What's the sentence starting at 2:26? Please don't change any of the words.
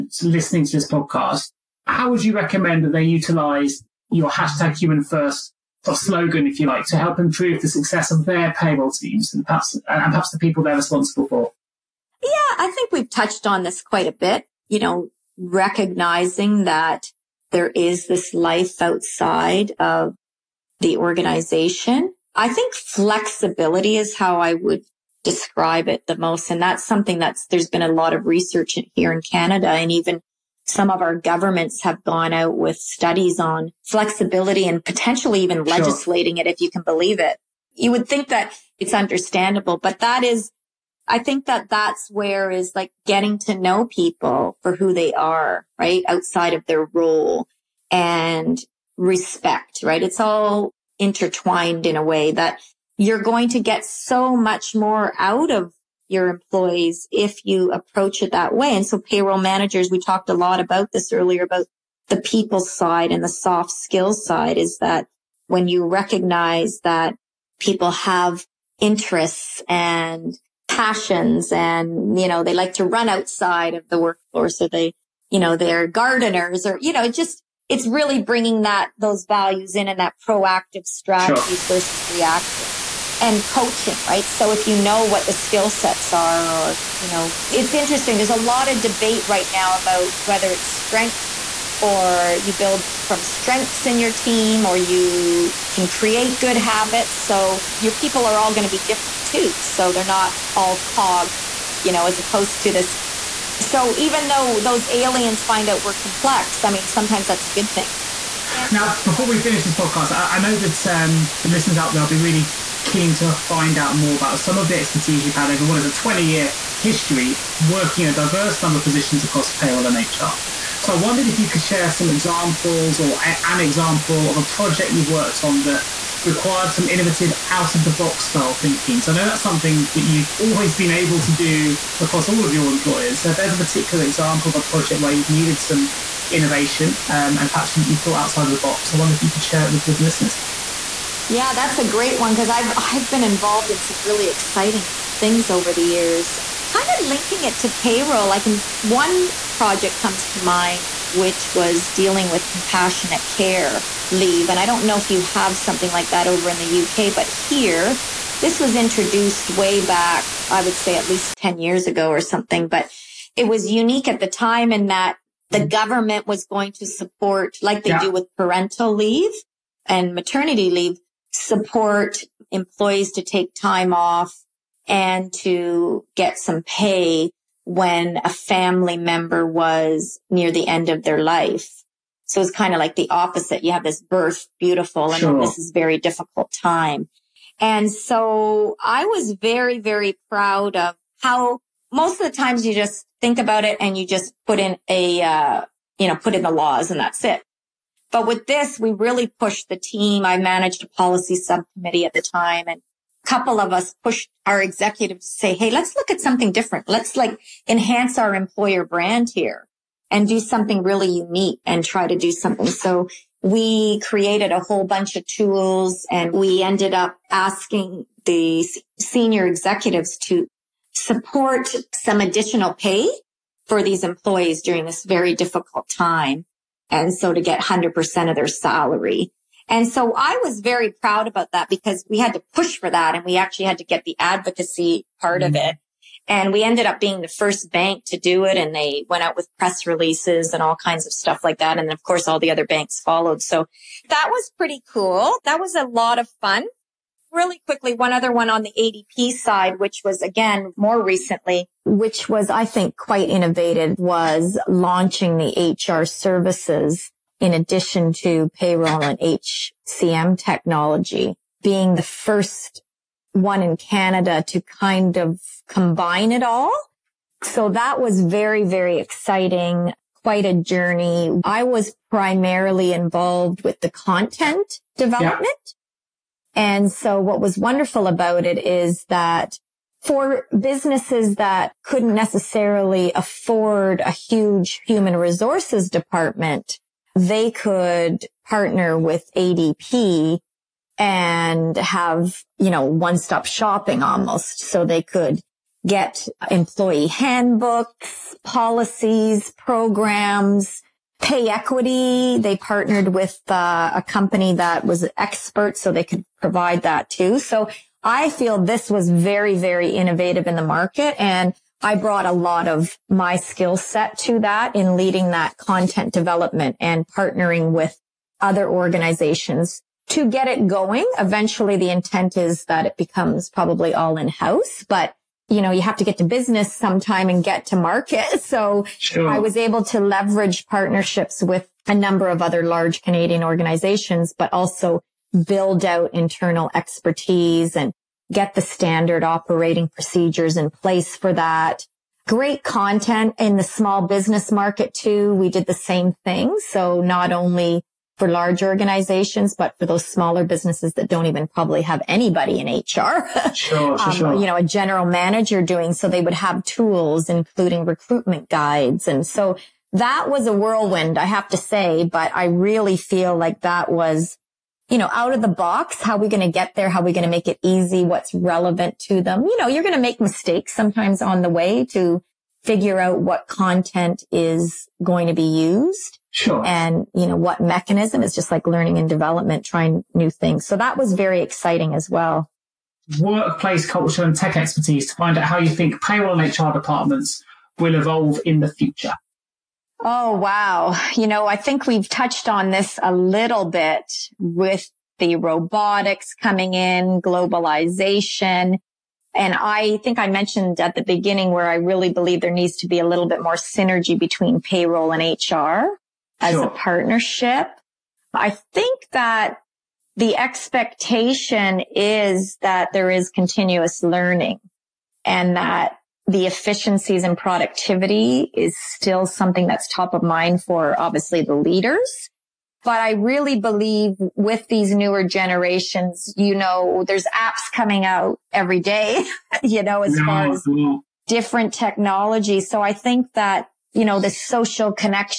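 Kind of linking it to payroll, I can, one project comes to mind, which was dealing with compassionate care leave.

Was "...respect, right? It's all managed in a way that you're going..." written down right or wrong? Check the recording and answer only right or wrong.
wrong.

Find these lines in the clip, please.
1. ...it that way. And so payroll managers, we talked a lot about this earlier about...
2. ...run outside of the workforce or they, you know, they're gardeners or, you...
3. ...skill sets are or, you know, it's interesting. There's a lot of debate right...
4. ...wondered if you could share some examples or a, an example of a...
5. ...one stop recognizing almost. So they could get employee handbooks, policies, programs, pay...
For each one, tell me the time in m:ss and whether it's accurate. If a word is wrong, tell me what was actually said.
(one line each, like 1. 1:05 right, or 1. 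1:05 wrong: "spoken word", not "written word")
1. 0:58 right
2. 1:12 right
3. 1:25 right
4. 2:00 right
5. 4:52 wrong: "shopping", not "recognizing".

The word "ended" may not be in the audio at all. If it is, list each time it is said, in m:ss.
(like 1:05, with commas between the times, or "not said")
3:36, 3:56.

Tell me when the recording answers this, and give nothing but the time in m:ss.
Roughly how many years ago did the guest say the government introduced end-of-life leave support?
2:41.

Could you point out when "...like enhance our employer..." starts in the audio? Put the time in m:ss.
3:27.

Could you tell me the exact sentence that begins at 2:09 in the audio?
So I know that's something that you've always been able to do across all of your employers.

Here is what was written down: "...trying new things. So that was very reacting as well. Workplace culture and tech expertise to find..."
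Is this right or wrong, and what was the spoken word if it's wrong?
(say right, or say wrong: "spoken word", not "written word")
wrong: "exciting", not "reacting".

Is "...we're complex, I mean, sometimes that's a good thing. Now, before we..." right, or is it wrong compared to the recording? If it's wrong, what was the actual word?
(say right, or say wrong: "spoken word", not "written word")
right.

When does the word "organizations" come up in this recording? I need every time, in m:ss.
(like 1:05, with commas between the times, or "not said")
0:20, 5:18, 5:33, 5:48.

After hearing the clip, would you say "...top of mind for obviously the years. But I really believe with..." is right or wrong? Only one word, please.
wrong.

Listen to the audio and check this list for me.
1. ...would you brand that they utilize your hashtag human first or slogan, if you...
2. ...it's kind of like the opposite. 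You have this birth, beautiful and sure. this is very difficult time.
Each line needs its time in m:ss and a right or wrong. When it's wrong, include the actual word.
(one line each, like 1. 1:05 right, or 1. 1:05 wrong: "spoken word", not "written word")
1. 0:02 wrong: "recommend", not "brand"
2. 3:02 right.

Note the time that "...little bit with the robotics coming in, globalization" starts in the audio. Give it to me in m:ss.
6:33.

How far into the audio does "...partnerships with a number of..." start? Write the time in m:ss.
5:30.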